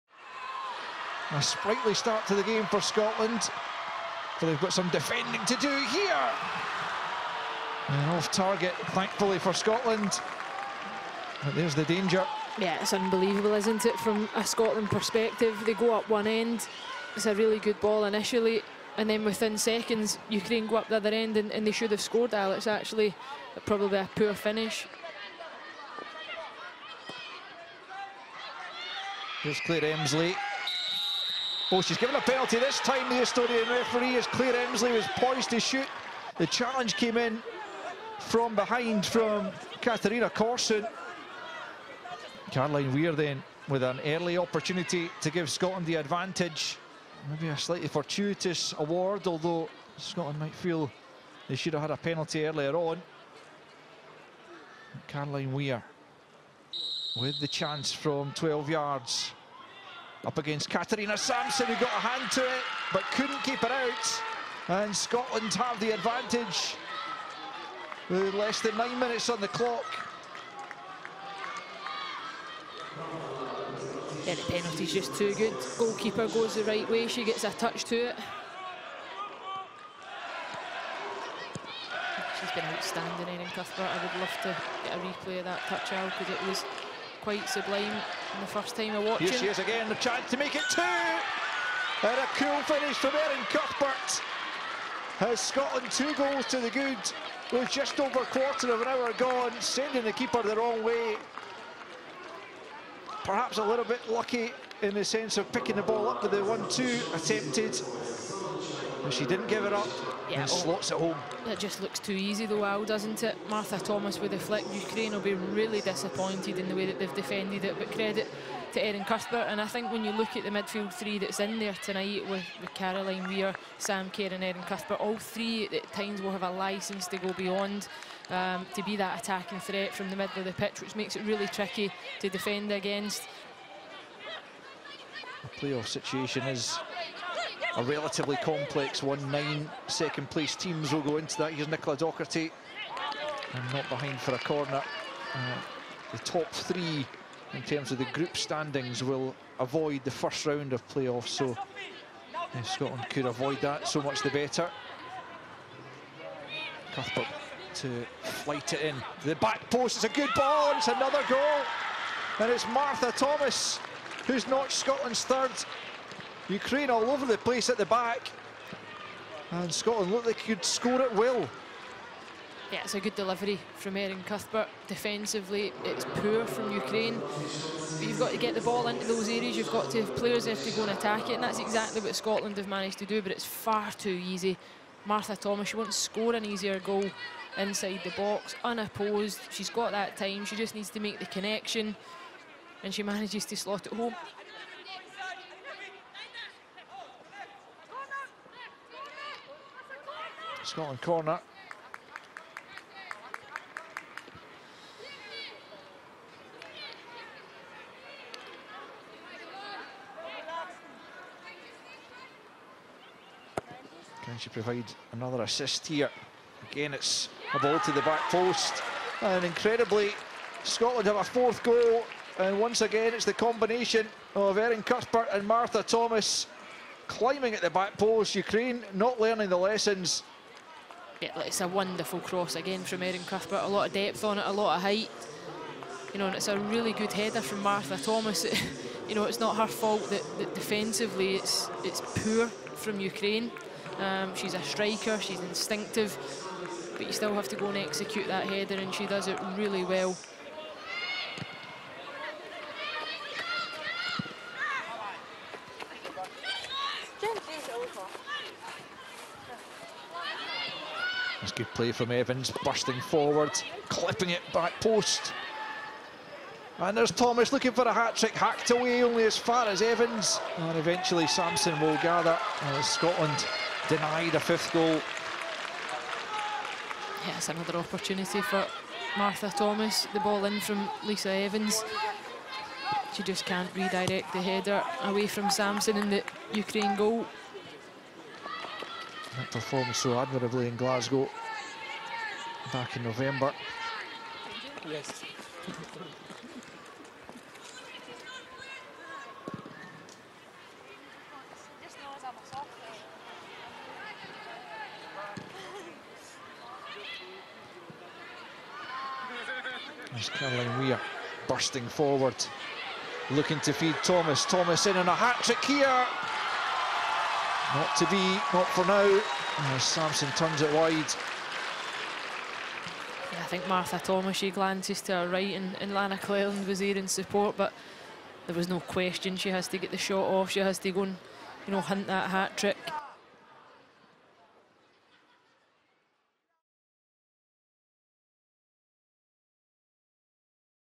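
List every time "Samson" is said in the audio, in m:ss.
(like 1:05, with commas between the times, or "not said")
1:01, 4:31, 4:45, 5:19.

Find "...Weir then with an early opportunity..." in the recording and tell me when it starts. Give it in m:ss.
0:42.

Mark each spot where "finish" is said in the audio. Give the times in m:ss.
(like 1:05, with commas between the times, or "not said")
0:24, 1:32.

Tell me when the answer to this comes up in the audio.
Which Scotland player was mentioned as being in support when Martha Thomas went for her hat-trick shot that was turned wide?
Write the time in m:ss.
5:25.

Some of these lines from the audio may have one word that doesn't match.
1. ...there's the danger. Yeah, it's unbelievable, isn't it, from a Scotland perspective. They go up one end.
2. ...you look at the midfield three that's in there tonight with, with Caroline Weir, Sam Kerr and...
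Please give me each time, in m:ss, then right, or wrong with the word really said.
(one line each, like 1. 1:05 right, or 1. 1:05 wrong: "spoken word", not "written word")
1. 0:11 right
2. 2:00 right.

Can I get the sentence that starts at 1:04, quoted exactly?
And Scotland have the advantage with less than nine minutes on the clock.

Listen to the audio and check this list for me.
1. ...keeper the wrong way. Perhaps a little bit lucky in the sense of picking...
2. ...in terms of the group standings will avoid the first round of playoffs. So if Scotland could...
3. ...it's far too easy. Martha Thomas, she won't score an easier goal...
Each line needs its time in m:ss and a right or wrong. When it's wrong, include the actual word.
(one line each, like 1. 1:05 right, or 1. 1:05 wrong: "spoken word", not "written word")
1. 1:40 right
2. 2:27 right
3. 3:03 right.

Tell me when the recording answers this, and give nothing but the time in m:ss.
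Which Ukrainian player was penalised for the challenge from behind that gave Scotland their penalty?
0:39.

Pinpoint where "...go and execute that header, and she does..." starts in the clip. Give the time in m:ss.
4:07.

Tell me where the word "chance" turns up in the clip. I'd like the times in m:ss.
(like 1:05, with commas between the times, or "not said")
0:57, 1:29.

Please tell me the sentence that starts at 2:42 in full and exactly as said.
And it's Martha Thomas who's notched Scotland's third Ukraine all over the place at the back.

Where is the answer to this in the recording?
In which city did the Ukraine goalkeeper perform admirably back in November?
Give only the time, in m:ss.
4:50.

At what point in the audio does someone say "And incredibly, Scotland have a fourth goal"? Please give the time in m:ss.
3:39.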